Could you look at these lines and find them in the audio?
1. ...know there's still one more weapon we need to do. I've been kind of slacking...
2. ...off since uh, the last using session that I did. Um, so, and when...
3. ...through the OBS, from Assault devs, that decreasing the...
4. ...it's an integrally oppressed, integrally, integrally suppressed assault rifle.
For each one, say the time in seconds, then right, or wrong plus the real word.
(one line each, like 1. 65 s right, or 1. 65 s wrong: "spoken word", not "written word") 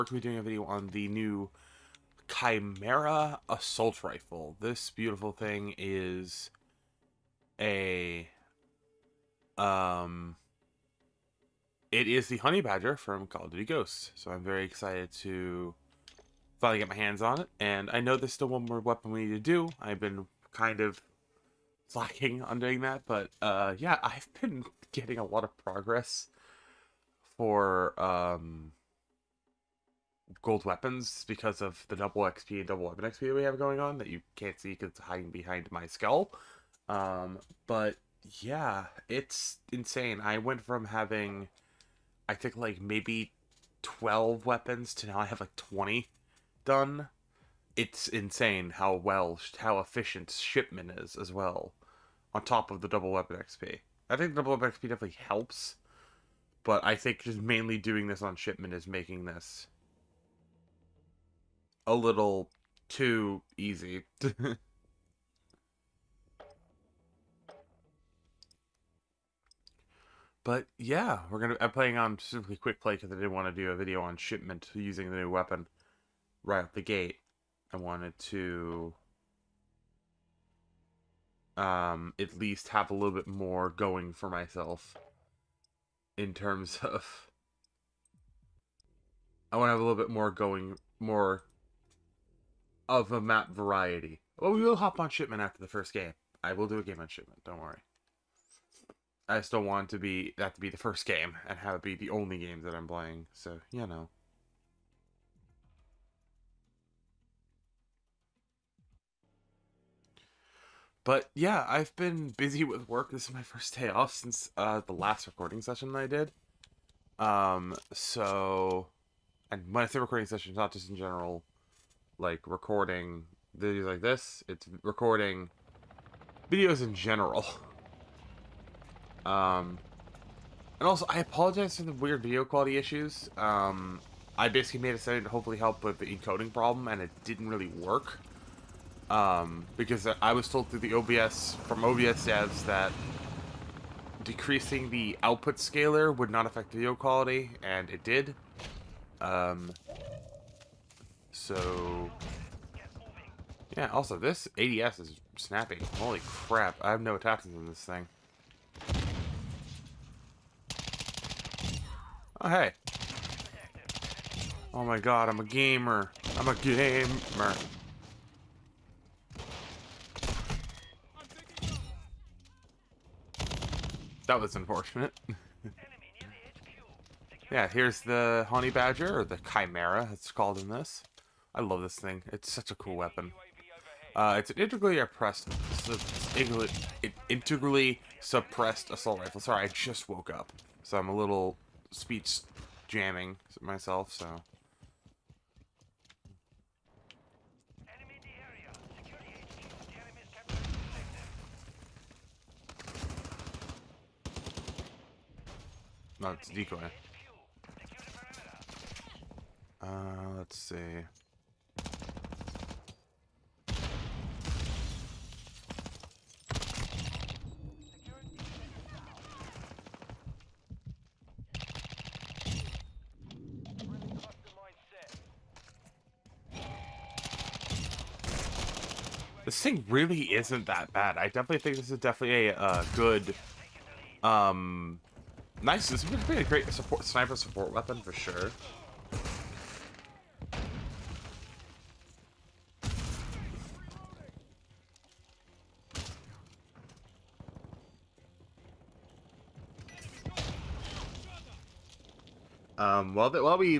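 1. 18 s right
2. 113 s wrong: "recording", not "using"
3. 140 s wrong: "OBS", not "Assault"
4. 184 s right.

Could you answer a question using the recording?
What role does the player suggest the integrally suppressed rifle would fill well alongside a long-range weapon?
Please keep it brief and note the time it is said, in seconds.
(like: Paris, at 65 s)
sniper support weapon, at 237 s.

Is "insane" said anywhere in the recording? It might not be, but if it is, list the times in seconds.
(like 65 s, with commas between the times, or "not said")
39 s, 48 s.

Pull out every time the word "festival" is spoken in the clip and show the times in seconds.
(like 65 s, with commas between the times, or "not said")
not said.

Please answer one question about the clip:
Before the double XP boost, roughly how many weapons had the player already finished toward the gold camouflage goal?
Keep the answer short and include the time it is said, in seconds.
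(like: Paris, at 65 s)
12, at 43 s.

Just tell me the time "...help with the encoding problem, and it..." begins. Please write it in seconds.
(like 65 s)
135 s.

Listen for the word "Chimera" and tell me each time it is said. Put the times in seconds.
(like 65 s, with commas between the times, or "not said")
2 s, 179 s.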